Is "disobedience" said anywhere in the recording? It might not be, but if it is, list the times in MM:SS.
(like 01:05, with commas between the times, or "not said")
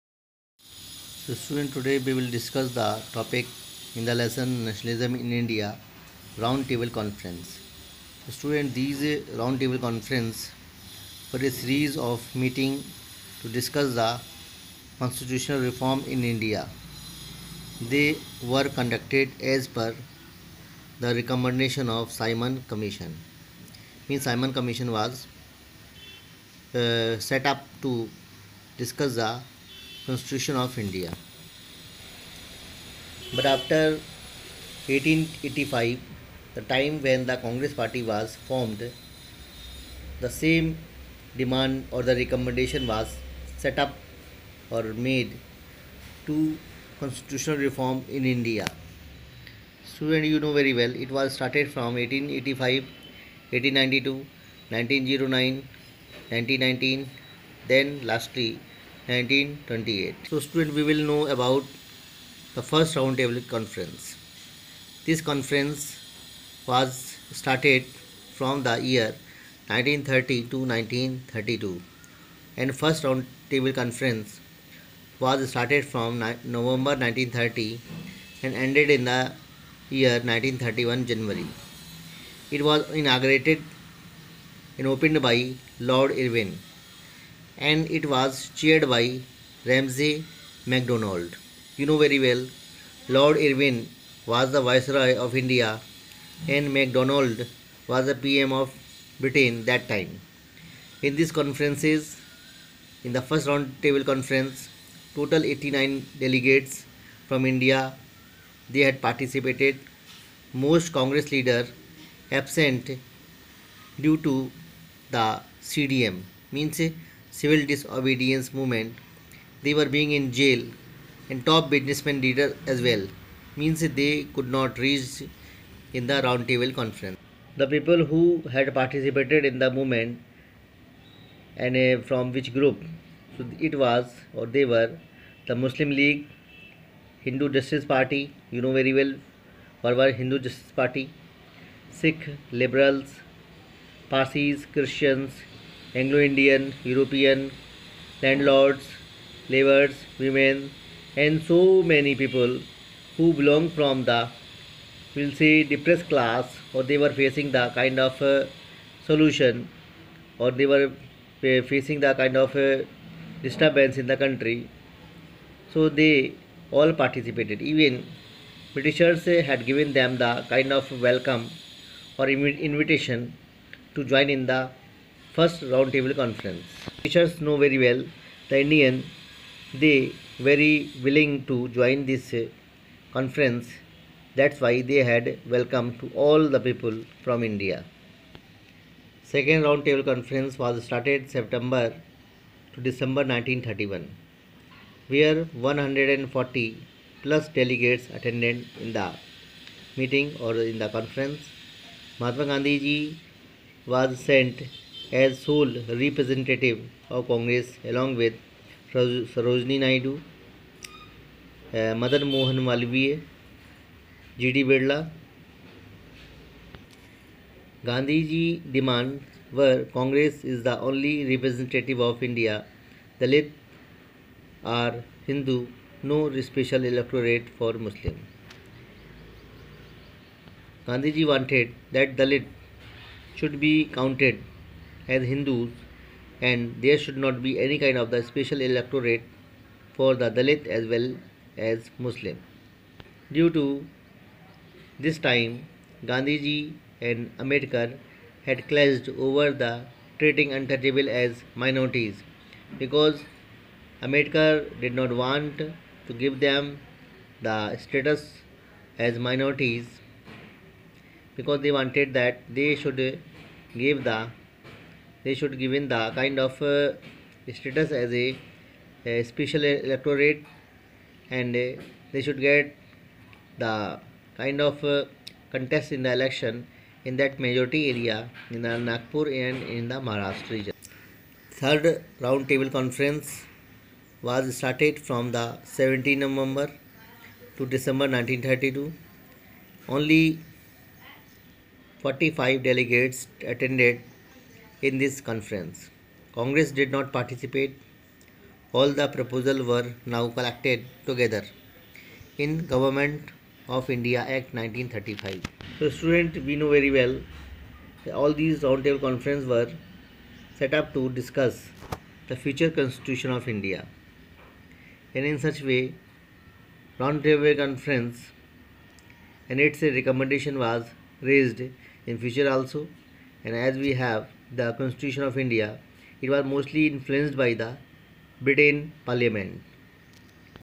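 01:57.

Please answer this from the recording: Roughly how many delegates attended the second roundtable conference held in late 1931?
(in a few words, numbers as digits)
140 plus.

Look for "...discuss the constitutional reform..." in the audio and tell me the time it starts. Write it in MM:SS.
00:13.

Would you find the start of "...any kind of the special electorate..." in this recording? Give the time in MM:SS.
03:57.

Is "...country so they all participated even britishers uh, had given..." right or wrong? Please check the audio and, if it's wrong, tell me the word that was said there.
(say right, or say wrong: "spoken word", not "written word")
right.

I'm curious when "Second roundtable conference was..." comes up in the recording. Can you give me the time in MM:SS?
03:09.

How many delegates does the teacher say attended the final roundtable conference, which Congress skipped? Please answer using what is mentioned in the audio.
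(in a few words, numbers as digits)
45.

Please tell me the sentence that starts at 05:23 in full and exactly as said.
And as we have the Constitution of India, it was mostly influenced by the Britain Parliament.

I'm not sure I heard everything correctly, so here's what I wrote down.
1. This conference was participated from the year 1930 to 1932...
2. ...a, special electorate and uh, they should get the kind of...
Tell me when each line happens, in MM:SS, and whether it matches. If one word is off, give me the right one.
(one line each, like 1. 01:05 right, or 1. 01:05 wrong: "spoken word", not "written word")
1. 01:05 wrong: "started", not "participated"
2. 04:29 right.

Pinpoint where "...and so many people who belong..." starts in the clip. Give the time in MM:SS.
02:31.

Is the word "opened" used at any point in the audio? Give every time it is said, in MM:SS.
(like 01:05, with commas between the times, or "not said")
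01:24.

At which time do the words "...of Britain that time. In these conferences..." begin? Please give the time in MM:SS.
01:38.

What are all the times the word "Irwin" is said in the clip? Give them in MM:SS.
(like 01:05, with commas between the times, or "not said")
01:26, 01:33.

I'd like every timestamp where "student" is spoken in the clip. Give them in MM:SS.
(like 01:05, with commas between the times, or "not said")
00:01, 00:08, 01:00, 05:05.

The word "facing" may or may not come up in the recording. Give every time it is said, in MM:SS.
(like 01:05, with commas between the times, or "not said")
02:37, 02:41.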